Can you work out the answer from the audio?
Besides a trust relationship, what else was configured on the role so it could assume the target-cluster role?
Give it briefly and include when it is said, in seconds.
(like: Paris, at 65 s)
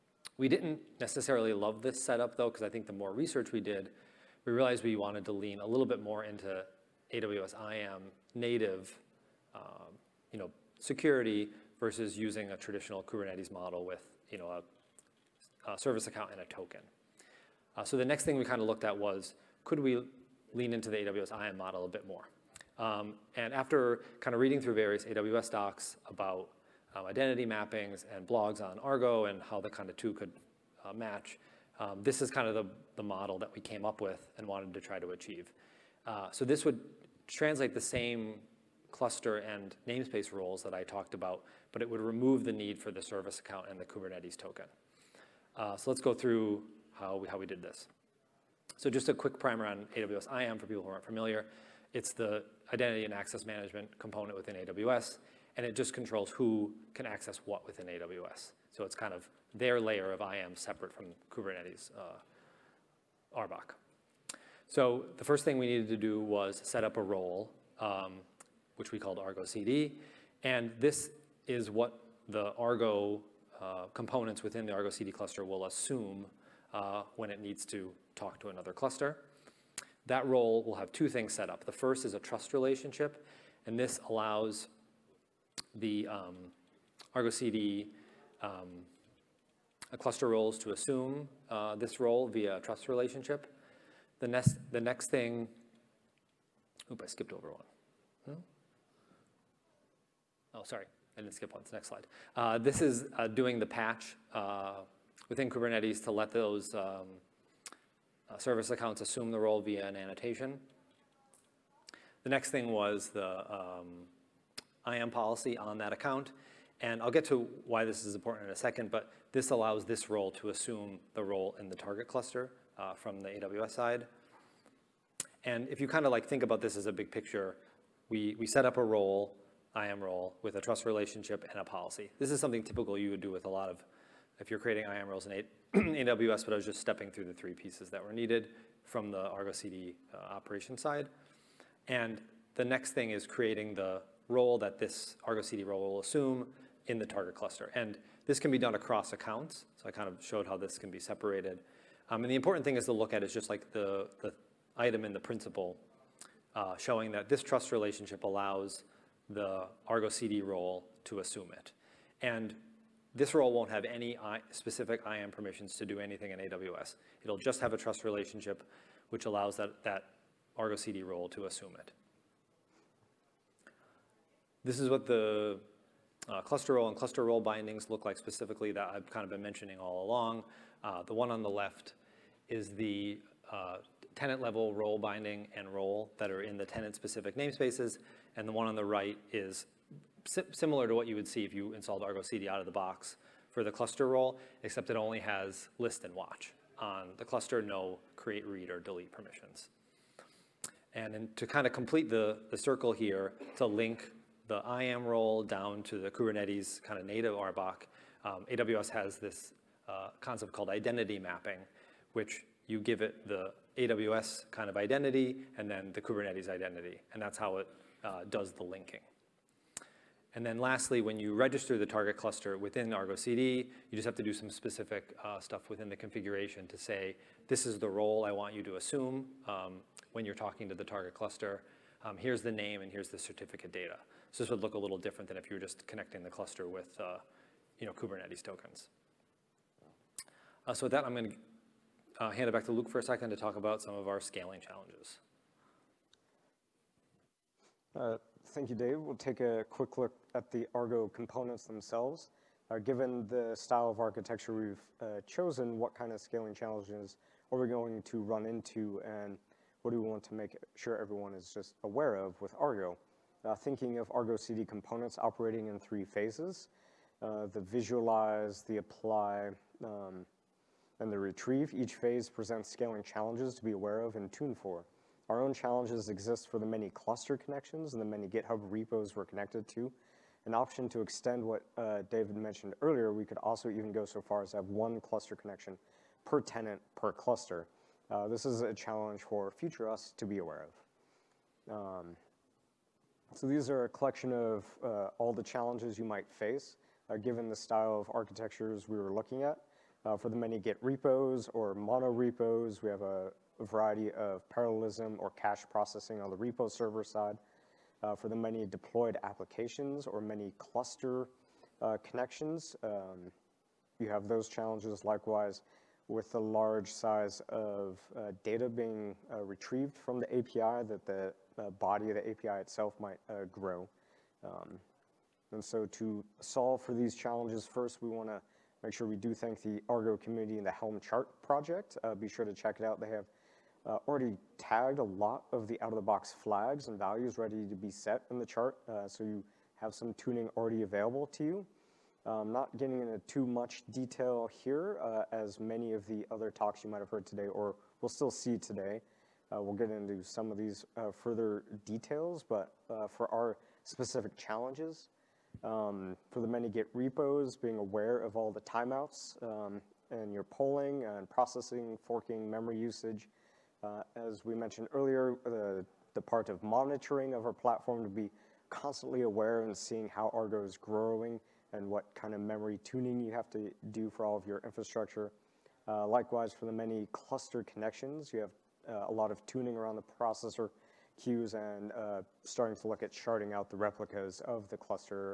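IAM policy, at 114 s.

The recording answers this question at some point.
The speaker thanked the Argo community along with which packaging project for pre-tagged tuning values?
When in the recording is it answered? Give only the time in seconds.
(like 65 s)
330 s.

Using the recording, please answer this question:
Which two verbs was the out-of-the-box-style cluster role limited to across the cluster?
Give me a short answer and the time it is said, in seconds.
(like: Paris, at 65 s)
list and watch, at 195 s.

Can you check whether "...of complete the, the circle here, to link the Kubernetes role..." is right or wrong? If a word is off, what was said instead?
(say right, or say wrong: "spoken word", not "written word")
wrong: "IAM", not "Kubernetes".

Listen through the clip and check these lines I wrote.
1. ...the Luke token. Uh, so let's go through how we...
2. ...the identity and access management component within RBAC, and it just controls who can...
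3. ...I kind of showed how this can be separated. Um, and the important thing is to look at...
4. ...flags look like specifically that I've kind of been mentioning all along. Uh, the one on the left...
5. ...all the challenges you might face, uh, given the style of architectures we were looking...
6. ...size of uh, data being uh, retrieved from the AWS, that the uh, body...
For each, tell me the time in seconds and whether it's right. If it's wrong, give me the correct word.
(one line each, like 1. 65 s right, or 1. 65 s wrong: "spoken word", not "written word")
1. 43 s wrong: "Kubernetes", not "Luke"
2. 52 s wrong: "AWS", not "RBAC"
3. 149 s right
4. 177 s wrong: "bindings", not "flags"
5. 295 s right
6. 316 s wrong: "API", not "AWS".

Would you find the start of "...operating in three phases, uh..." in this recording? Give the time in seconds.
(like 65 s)
265 s.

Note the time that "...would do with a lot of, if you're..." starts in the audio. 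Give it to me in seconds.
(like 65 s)
133 s.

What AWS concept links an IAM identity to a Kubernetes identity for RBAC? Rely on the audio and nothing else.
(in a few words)
identity mapping.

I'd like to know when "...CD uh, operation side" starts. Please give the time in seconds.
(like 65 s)
139 s.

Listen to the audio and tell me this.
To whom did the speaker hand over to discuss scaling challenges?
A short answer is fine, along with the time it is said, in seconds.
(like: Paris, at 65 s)
Luke, at 242 s.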